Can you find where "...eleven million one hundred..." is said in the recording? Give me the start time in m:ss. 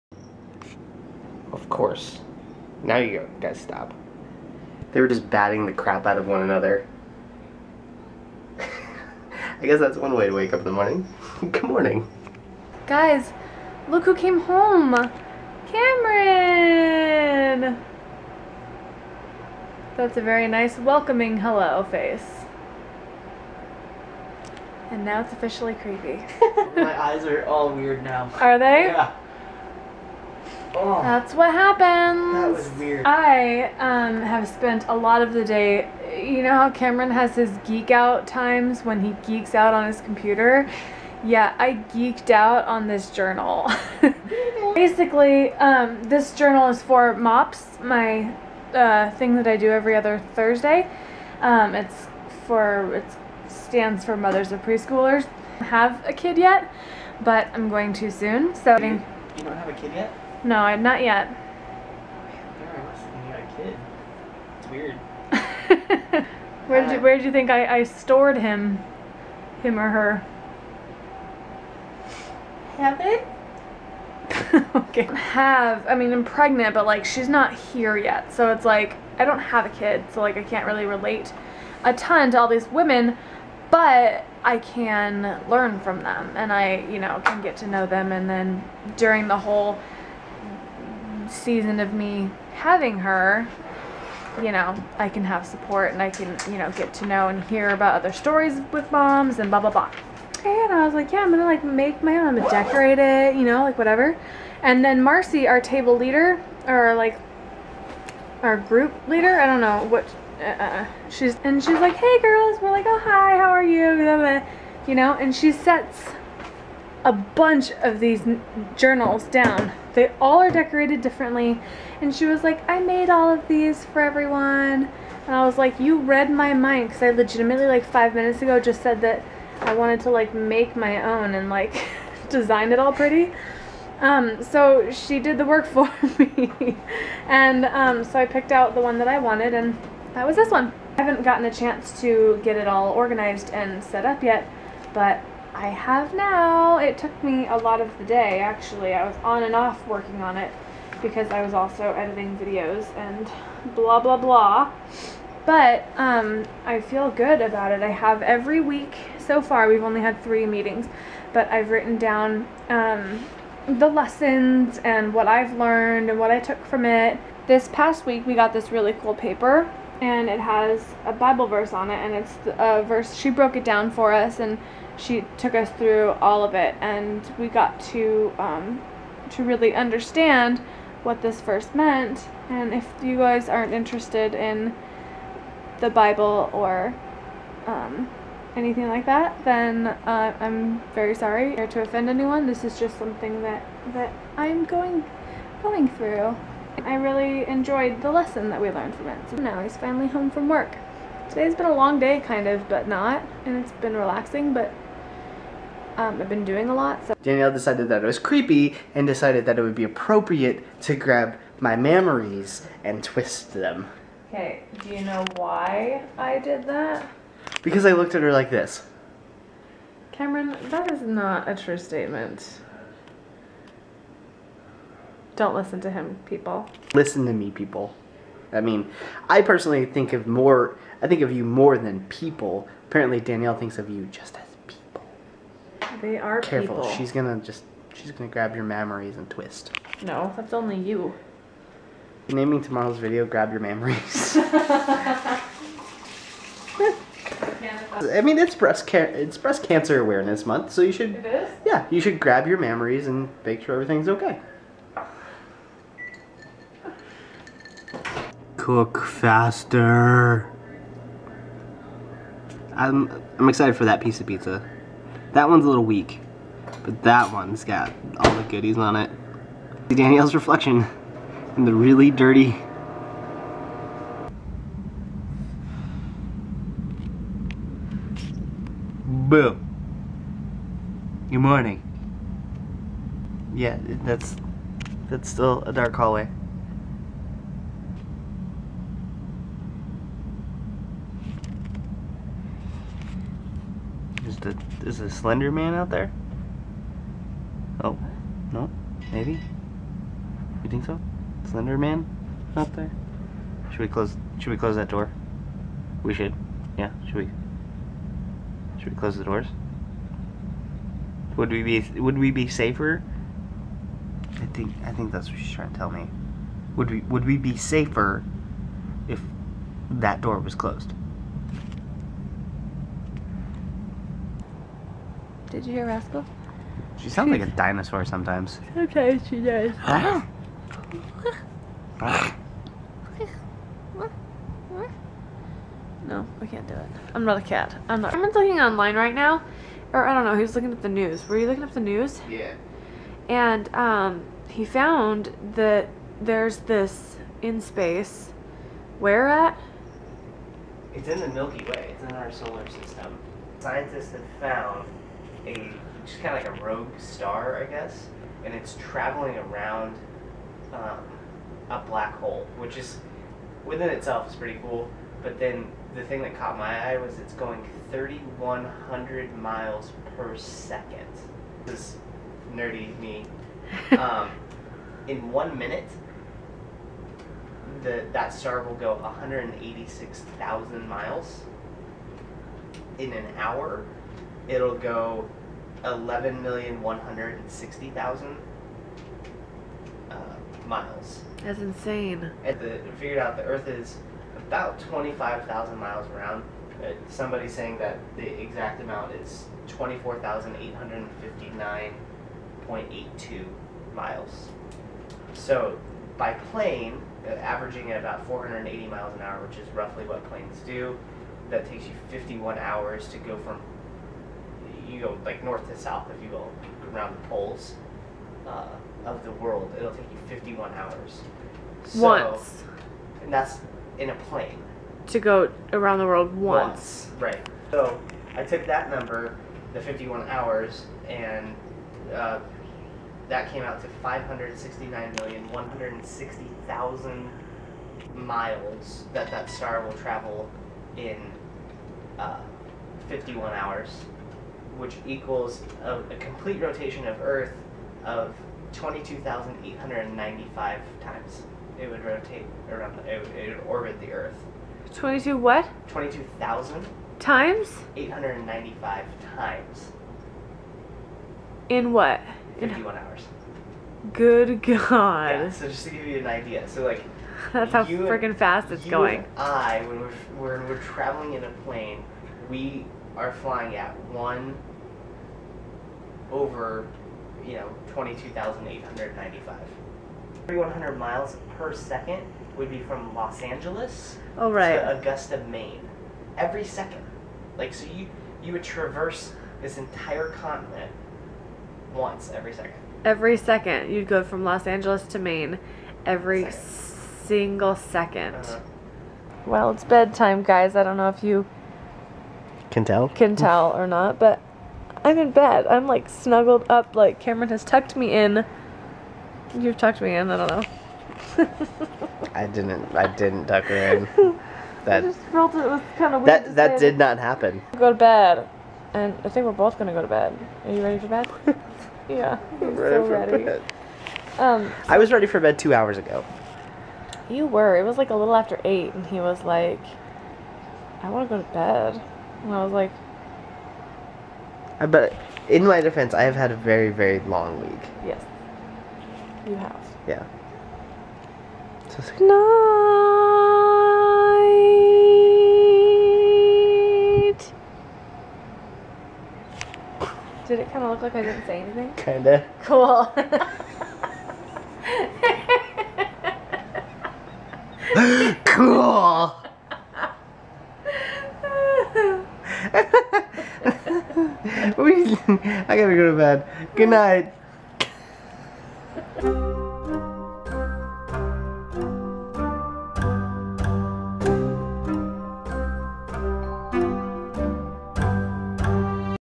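6:25.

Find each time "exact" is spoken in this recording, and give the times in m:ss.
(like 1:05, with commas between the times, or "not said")
6:38.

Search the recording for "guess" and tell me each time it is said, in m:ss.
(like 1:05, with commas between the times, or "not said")
0:09, 5:57.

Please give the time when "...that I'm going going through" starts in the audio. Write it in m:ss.
3:13.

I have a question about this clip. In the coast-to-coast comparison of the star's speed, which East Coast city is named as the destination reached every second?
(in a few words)
Augusta, Maine.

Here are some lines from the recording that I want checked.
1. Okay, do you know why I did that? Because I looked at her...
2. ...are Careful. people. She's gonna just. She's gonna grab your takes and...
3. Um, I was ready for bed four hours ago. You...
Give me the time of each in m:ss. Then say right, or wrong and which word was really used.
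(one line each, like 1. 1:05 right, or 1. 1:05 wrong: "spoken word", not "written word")
1. 3:34 right
2. 3:56 wrong: "mammaries", not "takes"
3. 8:44 wrong: "two", not "four".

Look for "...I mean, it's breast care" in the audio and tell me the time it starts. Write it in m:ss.
4:08.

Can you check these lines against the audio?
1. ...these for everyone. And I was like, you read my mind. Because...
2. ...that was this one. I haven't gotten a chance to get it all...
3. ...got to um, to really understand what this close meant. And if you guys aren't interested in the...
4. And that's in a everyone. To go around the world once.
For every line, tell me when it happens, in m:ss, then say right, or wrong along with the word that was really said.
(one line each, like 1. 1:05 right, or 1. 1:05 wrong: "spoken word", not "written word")
1. 2:03 right
2. 2:20 right
3. 2:57 wrong: "verse", not "close"
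4. 7:03 wrong: "plane", not "everyone".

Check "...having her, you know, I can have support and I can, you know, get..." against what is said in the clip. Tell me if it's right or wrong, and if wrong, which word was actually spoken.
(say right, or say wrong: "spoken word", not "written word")
right.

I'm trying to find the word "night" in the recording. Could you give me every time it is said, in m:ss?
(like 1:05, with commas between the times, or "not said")
9:02, 9:26.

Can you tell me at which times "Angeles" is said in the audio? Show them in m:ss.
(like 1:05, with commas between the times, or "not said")
8:03, 8:14.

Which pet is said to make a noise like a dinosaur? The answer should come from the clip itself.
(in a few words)
Rascal.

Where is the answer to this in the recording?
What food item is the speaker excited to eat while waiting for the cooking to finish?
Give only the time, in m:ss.
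4:24.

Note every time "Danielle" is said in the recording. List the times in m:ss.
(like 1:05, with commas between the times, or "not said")
3:27, 3:53, 4:29.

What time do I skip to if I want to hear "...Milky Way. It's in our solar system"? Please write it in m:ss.
5:51.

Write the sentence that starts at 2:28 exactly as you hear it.
I was on and off working on it because I was also editing videos and blah, blah, blah.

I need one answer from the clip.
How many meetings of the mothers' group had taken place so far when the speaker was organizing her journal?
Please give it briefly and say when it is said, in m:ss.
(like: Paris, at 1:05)
3, at 2:40.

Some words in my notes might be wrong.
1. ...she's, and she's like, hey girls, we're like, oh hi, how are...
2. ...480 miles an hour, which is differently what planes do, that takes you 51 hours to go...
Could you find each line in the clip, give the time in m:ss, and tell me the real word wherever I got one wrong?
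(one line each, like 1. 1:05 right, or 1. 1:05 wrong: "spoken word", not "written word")
1. 1:51 right
2. 6:48 wrong: "roughly", not "differently".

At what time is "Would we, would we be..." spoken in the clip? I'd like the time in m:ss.
5:16.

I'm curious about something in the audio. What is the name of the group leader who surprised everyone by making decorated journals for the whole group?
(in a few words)
Marcy.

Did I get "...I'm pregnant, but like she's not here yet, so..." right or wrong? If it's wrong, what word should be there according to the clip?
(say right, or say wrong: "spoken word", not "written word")
right.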